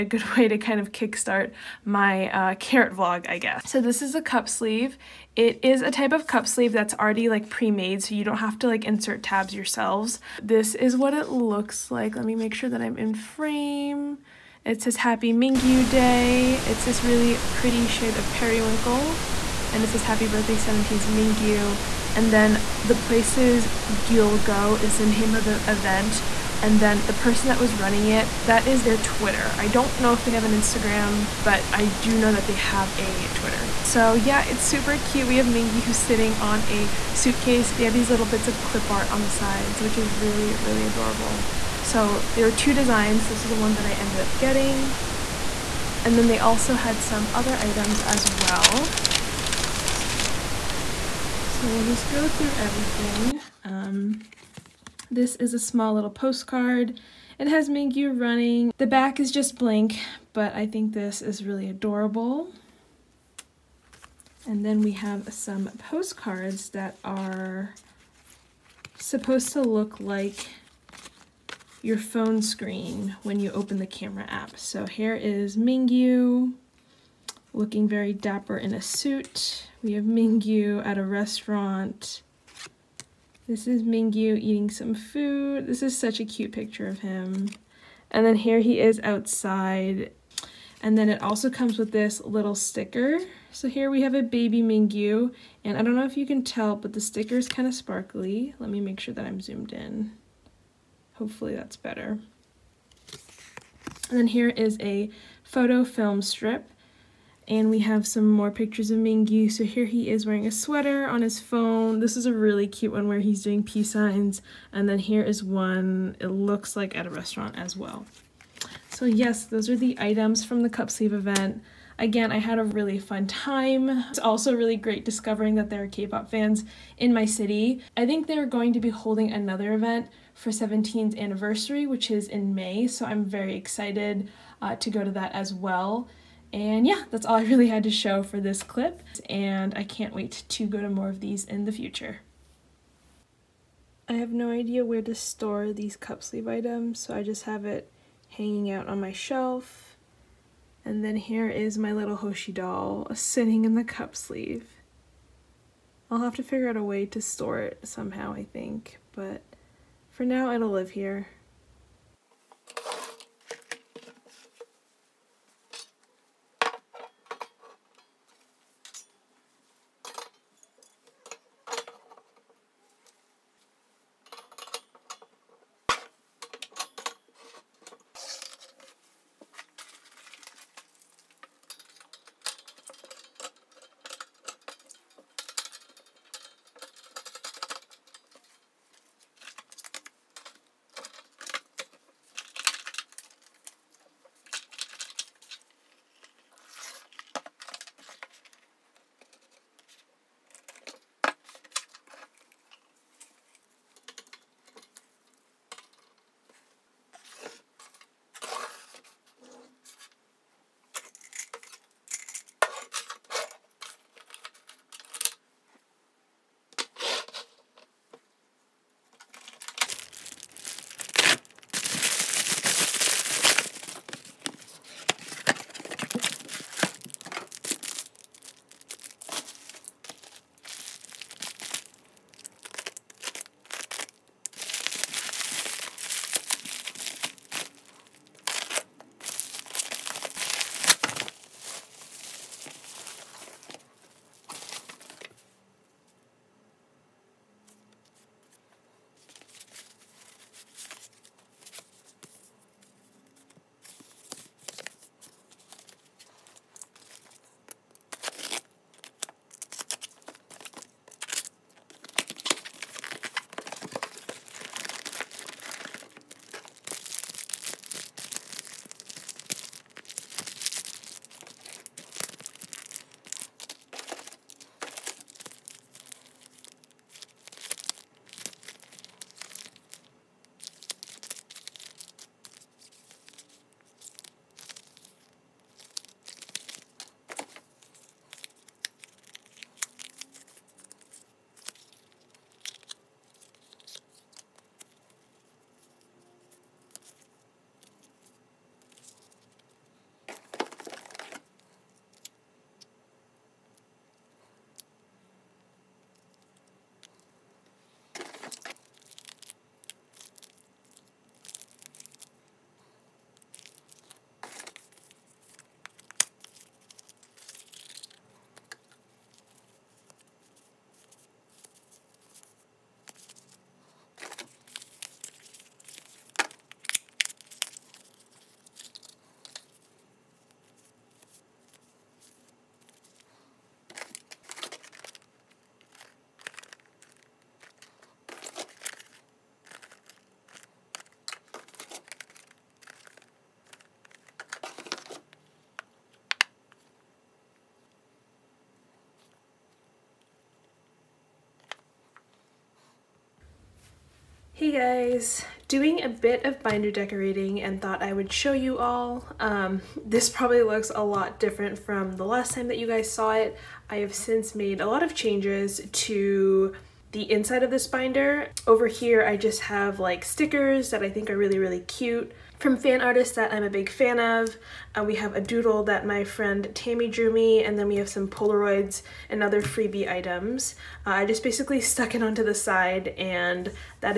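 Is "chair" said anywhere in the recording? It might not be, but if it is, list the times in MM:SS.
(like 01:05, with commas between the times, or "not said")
not said.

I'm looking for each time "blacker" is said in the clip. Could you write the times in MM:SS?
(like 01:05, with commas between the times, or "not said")
not said.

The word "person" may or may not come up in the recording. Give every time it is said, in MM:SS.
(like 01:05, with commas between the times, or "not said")
00:27.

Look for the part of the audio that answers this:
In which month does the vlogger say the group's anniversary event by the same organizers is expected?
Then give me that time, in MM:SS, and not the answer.
02:12.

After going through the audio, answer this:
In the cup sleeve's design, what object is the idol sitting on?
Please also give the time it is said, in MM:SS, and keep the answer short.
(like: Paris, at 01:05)
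a suitcase, at 00:36.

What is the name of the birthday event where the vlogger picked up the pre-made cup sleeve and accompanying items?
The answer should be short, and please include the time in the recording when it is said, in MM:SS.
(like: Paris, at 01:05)
Gyul Go, at 00:23.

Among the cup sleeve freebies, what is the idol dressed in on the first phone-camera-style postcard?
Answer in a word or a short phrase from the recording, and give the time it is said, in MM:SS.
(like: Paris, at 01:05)
a suit, at 01:18.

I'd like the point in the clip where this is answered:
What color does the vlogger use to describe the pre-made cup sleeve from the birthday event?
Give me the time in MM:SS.
00:18.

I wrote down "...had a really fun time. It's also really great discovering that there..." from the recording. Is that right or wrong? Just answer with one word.
right.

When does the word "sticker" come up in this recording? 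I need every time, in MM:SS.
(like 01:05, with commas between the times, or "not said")
01:32, 01:36, 06:10.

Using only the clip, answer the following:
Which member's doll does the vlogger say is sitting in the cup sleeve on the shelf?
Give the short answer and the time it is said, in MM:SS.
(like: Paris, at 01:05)
Hoshi, at 02:32.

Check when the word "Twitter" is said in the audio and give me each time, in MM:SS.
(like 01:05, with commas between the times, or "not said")
00:28, 00:33.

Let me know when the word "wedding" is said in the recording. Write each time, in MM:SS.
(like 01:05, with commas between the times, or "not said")
not said.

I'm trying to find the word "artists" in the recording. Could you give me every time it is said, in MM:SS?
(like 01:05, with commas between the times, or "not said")
06:13.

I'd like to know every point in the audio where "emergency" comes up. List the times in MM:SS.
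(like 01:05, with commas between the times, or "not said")
not said.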